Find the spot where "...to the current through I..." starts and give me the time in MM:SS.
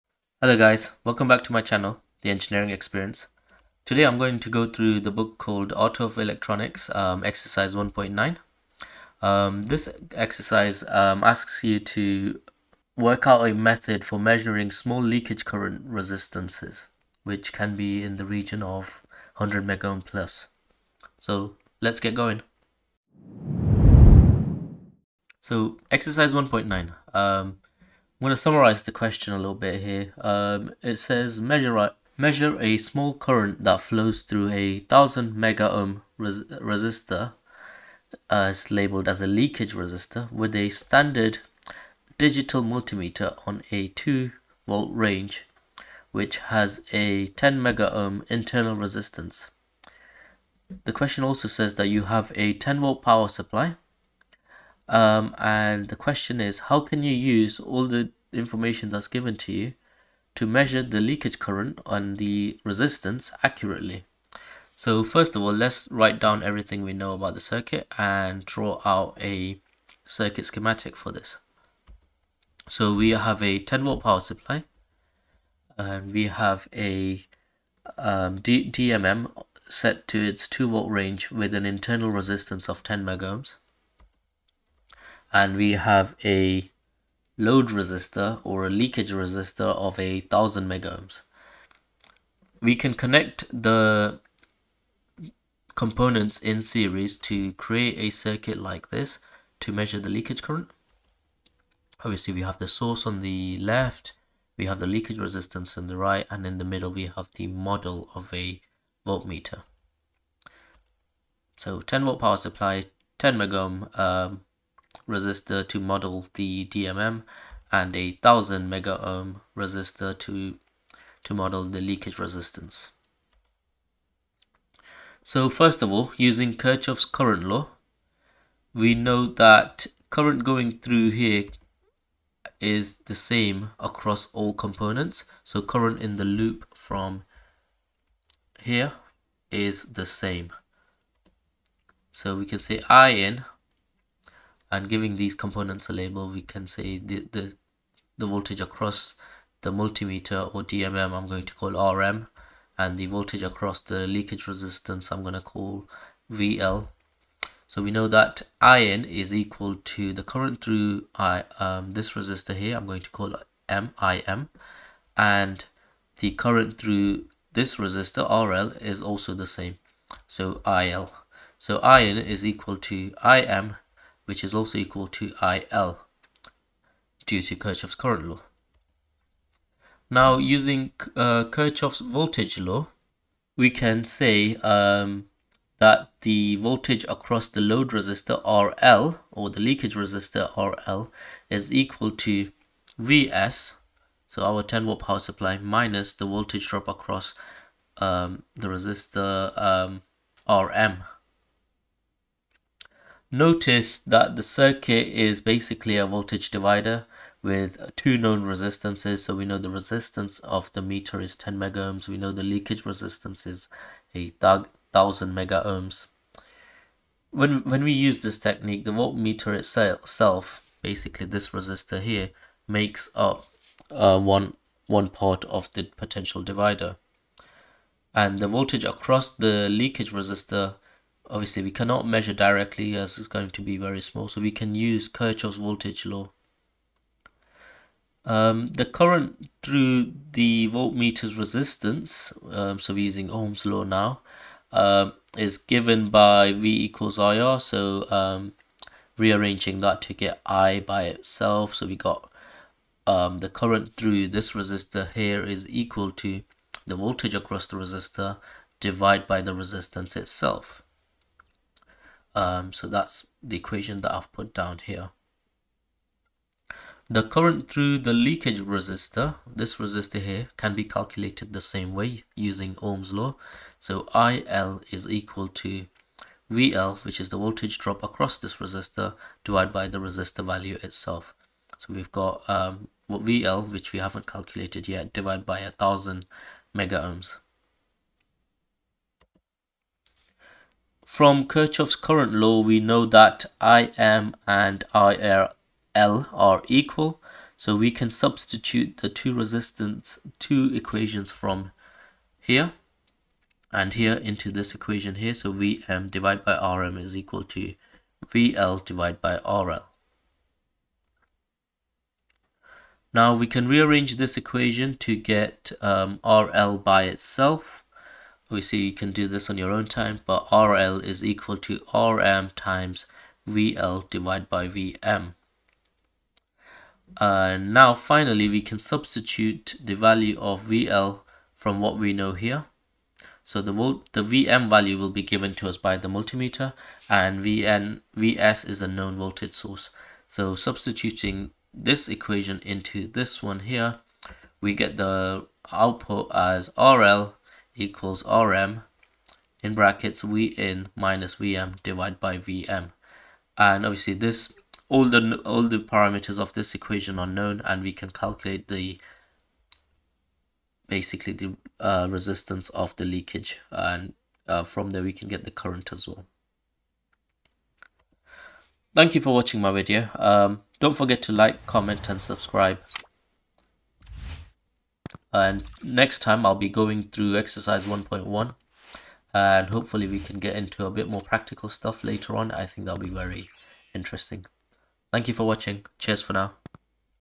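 02:39.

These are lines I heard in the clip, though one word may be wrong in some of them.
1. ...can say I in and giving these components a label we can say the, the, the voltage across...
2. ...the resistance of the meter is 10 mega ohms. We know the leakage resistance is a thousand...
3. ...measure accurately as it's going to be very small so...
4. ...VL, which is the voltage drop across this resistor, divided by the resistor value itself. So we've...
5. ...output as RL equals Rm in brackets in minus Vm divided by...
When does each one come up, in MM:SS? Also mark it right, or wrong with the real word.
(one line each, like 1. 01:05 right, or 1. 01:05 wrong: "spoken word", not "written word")
1. 02:22 right
2. 03:29 right
3. 03:52 wrong: "directly", not "accurately"
4. 04:36 right
5. 05:45 right.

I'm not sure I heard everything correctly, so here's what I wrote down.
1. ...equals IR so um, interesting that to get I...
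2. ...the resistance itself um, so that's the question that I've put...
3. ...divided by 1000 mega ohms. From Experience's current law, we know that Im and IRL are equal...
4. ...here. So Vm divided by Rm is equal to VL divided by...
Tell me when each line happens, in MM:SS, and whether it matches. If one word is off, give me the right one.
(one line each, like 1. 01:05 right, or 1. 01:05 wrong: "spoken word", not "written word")
1. 04:06 wrong: "rearranging", not "interesting"
2. 04:19 wrong: "equation", not "question"
3. 04:45 wrong: "Kirchhoff", not "Experience"
4. 05:05 right.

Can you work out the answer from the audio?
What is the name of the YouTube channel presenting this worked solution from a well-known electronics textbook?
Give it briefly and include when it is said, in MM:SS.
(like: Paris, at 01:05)
The Engineering Experience, at 00:02.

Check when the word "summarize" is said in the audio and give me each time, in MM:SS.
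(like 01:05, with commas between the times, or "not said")
00:28.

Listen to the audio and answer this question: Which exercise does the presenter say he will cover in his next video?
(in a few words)
1.1.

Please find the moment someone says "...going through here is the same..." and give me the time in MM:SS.
02:10.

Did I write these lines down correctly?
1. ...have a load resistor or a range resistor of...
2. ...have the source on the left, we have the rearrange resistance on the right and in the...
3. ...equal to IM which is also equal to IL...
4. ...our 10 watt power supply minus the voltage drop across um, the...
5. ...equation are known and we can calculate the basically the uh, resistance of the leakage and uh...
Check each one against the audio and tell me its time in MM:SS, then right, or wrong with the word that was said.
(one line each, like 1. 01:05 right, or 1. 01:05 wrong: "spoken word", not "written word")
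1. 01:25 wrong: "leakage", not "range"
2. 01:42 wrong: "leakage", not "rearrange"
3. 02:52 right
4. 03:14 right
5. 05:56 right.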